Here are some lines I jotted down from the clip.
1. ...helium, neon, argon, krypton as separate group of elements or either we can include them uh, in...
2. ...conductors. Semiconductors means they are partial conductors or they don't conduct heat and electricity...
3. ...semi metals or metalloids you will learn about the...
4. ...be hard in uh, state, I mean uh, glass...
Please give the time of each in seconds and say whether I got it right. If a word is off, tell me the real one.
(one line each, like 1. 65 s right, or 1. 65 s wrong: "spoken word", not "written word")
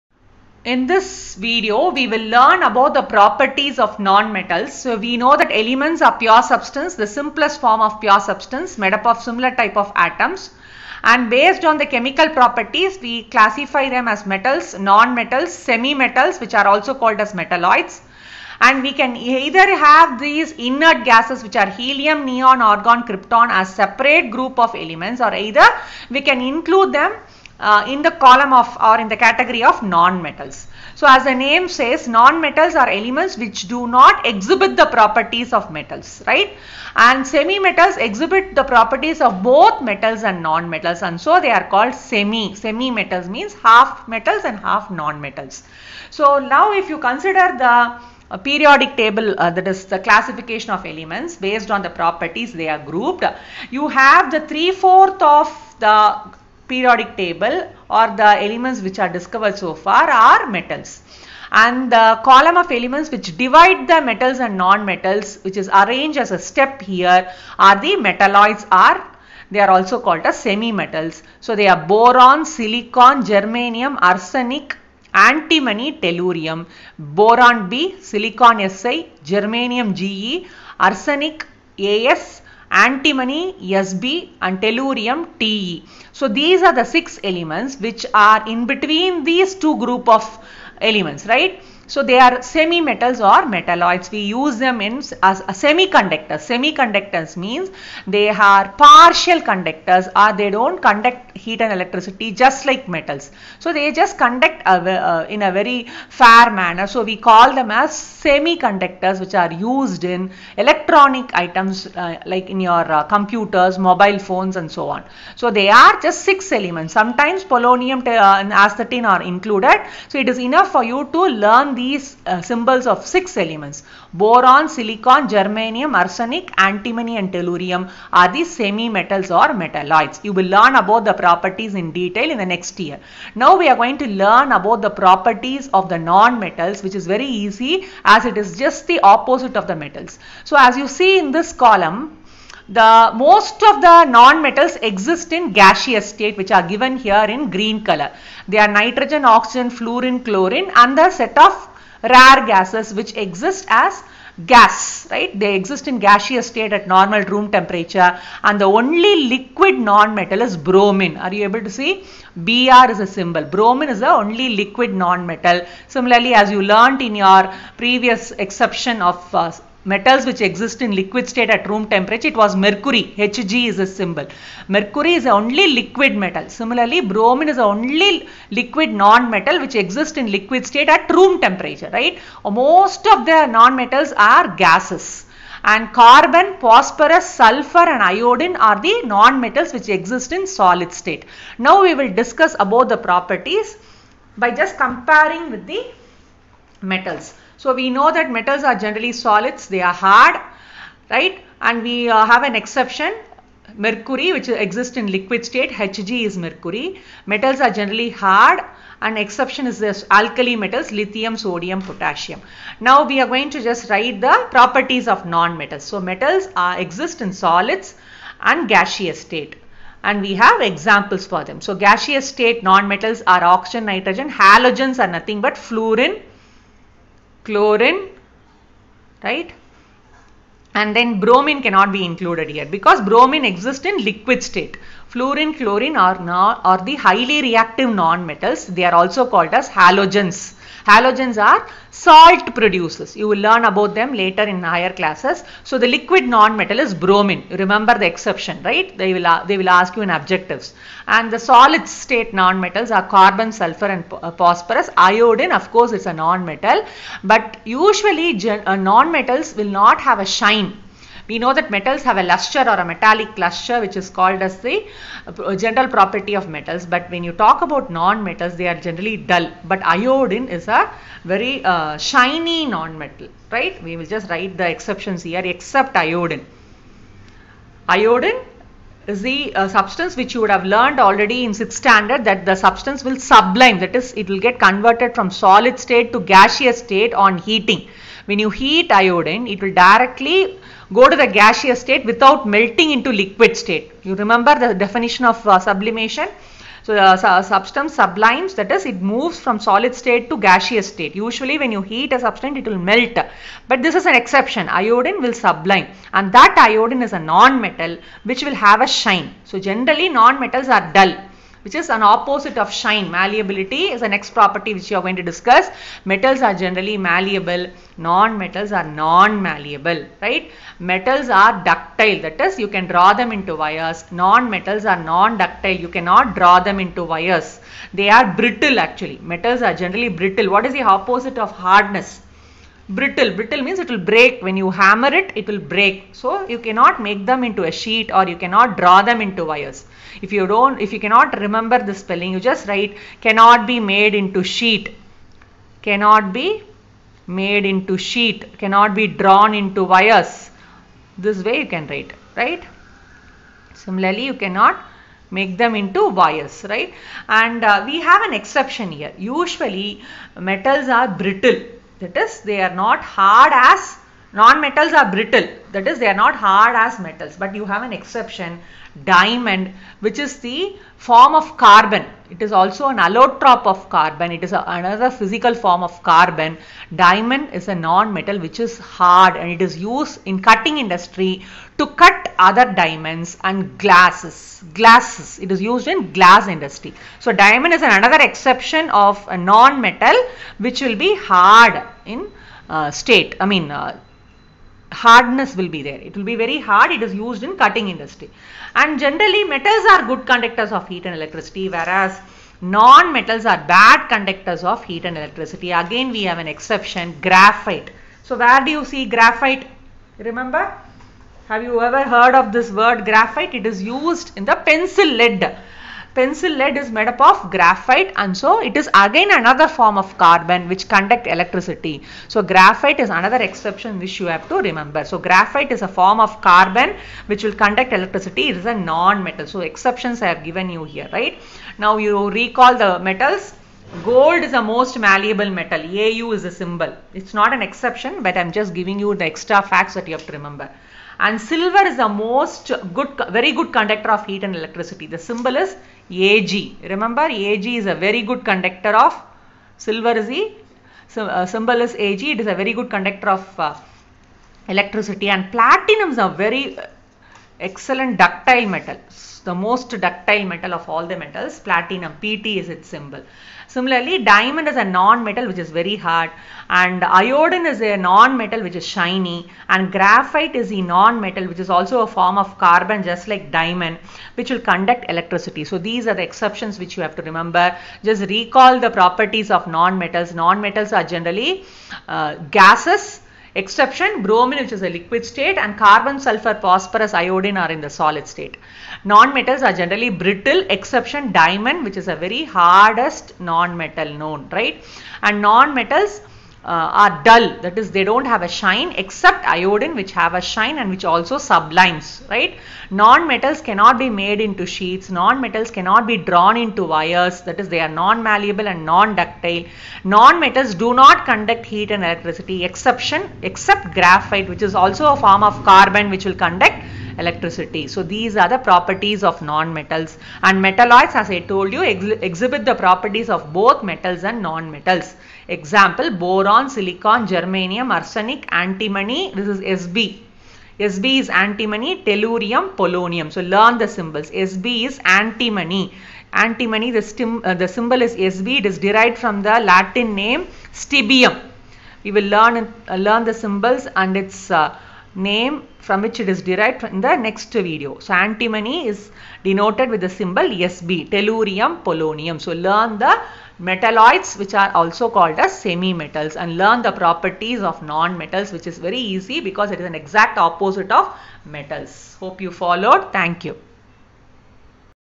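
1. 21 s right
2. 95 s wrong: "semiconductors", not "conductors"
3. 128 s right
4. 390 s wrong: "hardness", not "glass".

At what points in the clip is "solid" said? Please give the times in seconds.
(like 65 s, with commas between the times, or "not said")
190 s, 199 s, 217 s, 251 s, 285 s, 299 s, 487 s.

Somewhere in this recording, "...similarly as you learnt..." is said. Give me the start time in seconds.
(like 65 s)
165 s.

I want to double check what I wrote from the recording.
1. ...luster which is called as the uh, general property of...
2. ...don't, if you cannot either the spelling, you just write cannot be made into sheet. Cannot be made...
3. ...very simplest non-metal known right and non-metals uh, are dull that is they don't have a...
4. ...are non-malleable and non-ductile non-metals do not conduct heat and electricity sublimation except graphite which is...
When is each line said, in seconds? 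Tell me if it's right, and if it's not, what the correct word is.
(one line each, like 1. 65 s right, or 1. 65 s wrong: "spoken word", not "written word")
1. 263 s right
2. 340 s wrong: "remember", not "either"
3. 492 s wrong: "hardest", not "simplest"
4. 507 s wrong: "exception", not "sublimation".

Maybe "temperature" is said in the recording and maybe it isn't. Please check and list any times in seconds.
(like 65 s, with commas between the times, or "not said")
157 s, 171 s, 181 s.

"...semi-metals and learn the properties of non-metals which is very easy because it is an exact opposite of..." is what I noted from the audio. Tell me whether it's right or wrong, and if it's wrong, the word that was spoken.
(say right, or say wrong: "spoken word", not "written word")
right.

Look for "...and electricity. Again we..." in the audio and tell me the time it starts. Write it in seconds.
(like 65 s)
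405 s.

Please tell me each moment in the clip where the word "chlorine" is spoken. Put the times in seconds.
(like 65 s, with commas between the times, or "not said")
150 s, 227 s, 235 s.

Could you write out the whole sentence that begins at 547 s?
So antimony is denoted with the symbol SB, tellurium, polonium.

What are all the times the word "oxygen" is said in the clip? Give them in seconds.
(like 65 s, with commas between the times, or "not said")
149 s, 223 s.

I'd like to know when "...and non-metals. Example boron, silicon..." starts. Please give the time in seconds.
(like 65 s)
524 s.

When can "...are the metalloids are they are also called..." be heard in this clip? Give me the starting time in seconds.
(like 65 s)
67 s.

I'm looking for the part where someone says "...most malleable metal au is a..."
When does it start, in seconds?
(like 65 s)
434 s.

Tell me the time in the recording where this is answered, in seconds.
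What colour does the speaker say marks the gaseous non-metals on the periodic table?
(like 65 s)
147 s.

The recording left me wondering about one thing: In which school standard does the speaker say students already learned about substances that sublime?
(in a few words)
6th standard.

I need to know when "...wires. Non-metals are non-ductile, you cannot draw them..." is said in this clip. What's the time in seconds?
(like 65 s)
323 s.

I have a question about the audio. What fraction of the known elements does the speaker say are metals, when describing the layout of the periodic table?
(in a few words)
three-fourth.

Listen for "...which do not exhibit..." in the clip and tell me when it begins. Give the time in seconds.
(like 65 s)
33 s.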